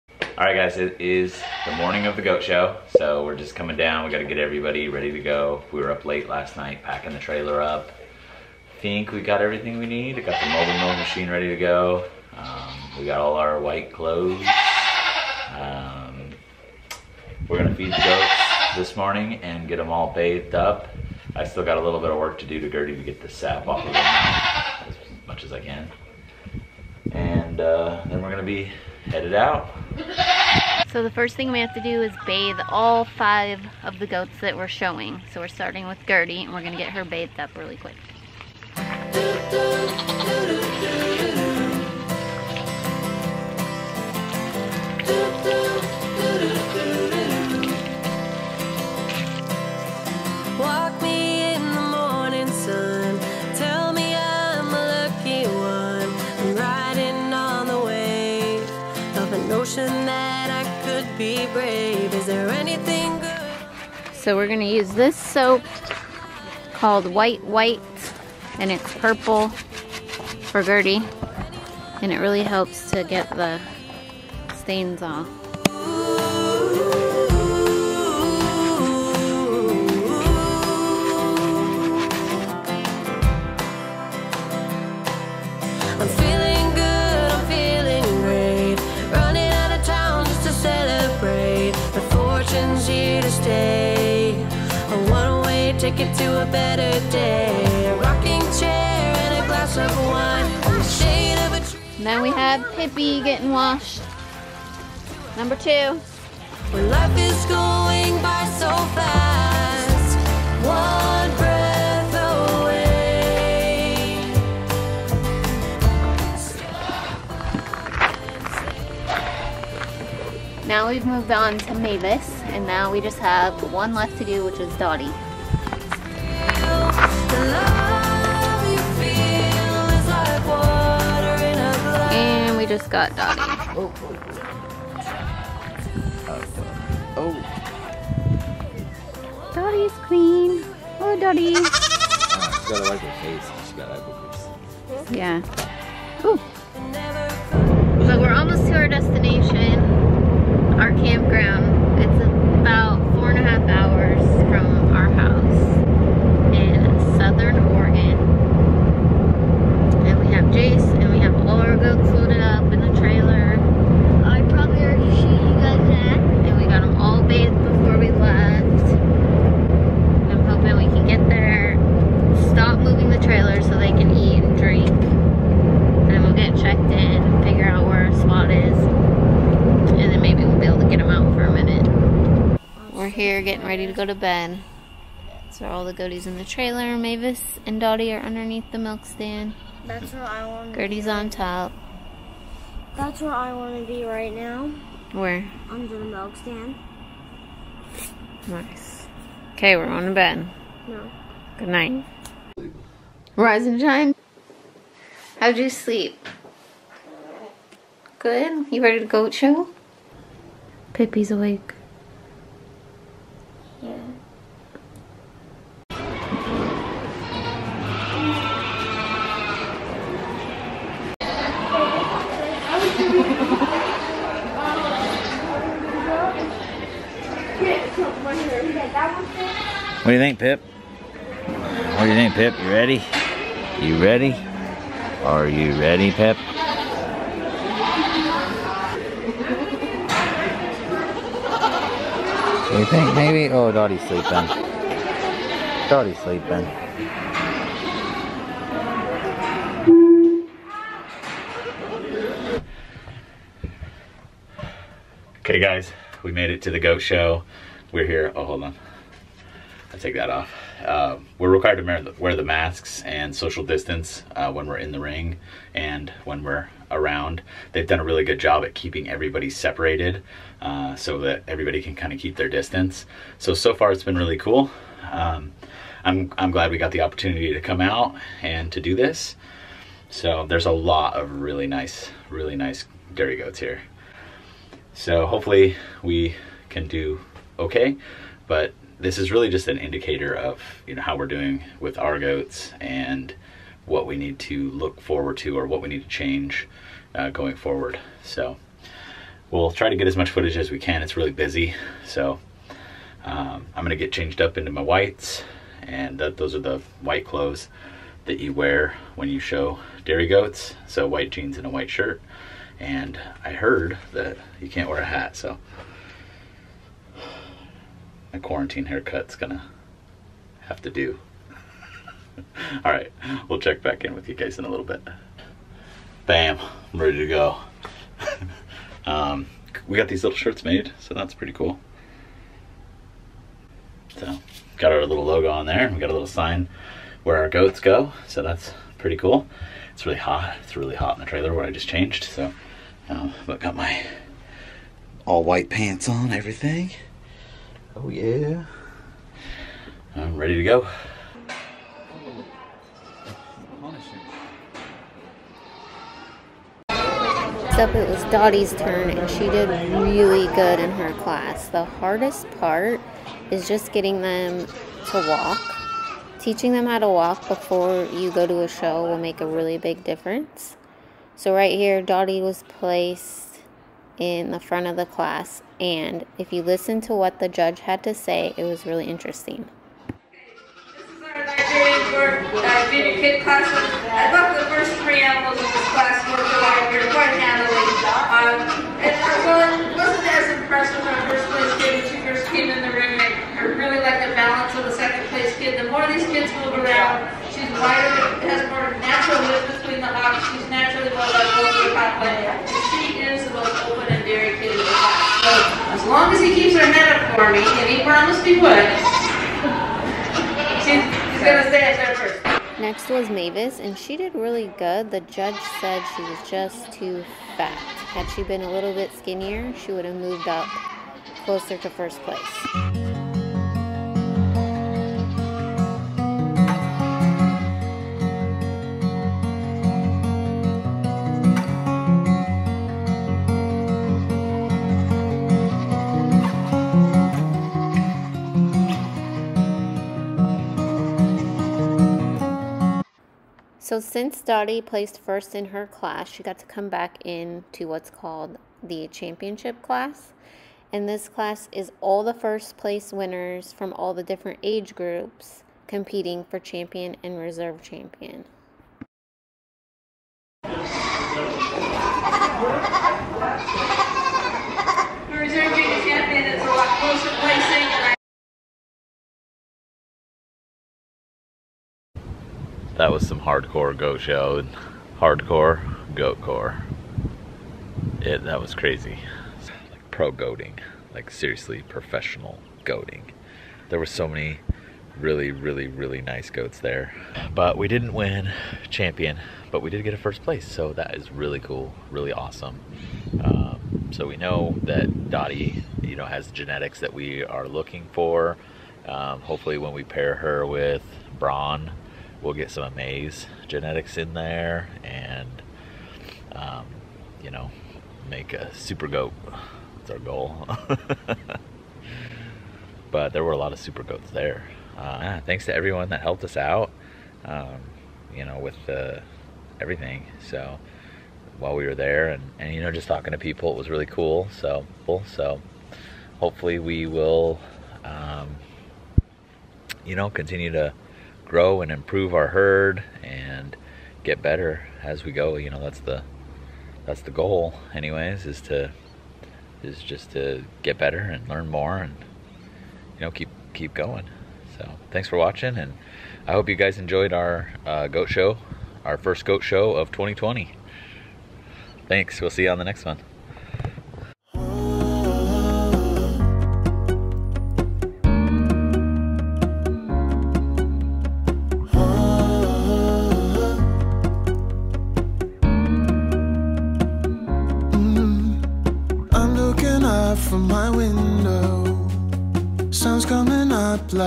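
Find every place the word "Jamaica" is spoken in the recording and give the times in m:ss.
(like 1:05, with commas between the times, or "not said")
not said.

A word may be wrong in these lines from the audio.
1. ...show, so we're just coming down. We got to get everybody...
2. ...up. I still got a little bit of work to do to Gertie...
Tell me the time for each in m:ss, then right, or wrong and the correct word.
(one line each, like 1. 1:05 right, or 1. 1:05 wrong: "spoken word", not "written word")
1. 0:02 right
2. 0:20 right.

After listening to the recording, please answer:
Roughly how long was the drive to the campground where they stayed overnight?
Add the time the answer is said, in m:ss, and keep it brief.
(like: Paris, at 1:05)
four and a half hours, at 2:33.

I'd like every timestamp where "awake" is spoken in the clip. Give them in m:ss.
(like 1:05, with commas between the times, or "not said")
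3:31.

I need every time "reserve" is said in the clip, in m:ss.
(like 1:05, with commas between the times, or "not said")
7:37, 7:45.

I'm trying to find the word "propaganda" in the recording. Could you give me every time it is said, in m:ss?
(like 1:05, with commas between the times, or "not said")
not said.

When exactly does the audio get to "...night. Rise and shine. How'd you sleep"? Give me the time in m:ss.
3:21.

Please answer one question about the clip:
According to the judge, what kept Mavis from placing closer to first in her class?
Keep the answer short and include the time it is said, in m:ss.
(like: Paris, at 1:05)
too fat, at 6:56.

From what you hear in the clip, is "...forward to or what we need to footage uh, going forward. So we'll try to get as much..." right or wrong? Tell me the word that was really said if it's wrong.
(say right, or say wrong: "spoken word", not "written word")
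wrong: "change", not "footage".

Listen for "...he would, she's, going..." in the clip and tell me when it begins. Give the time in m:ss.
6:48.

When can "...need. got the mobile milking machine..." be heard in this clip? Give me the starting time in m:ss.
0:09.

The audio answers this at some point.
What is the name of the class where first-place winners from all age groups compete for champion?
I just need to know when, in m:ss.
7:29.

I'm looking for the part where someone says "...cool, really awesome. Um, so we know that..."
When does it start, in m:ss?
8:11.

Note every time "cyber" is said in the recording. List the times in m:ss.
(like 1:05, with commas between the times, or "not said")
not said.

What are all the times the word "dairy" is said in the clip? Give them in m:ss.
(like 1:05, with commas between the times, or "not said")
4:43, 5:10.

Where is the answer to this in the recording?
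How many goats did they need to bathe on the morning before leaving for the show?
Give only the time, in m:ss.
0:33.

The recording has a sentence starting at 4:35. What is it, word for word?
Um, I'm, I'm glad we got the opportunity to come out and to do this.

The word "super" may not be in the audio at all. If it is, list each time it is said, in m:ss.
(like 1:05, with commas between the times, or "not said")
8:28, 8:33.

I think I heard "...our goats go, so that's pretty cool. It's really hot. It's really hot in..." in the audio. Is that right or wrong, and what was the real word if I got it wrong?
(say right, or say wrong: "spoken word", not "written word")
right.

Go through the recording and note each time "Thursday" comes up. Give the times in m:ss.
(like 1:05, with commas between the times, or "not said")
not said.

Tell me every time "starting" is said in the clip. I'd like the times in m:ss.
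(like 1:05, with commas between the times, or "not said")
0:35.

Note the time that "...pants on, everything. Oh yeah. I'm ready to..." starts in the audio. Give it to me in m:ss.
5:45.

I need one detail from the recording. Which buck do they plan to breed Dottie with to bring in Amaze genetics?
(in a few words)
Braun.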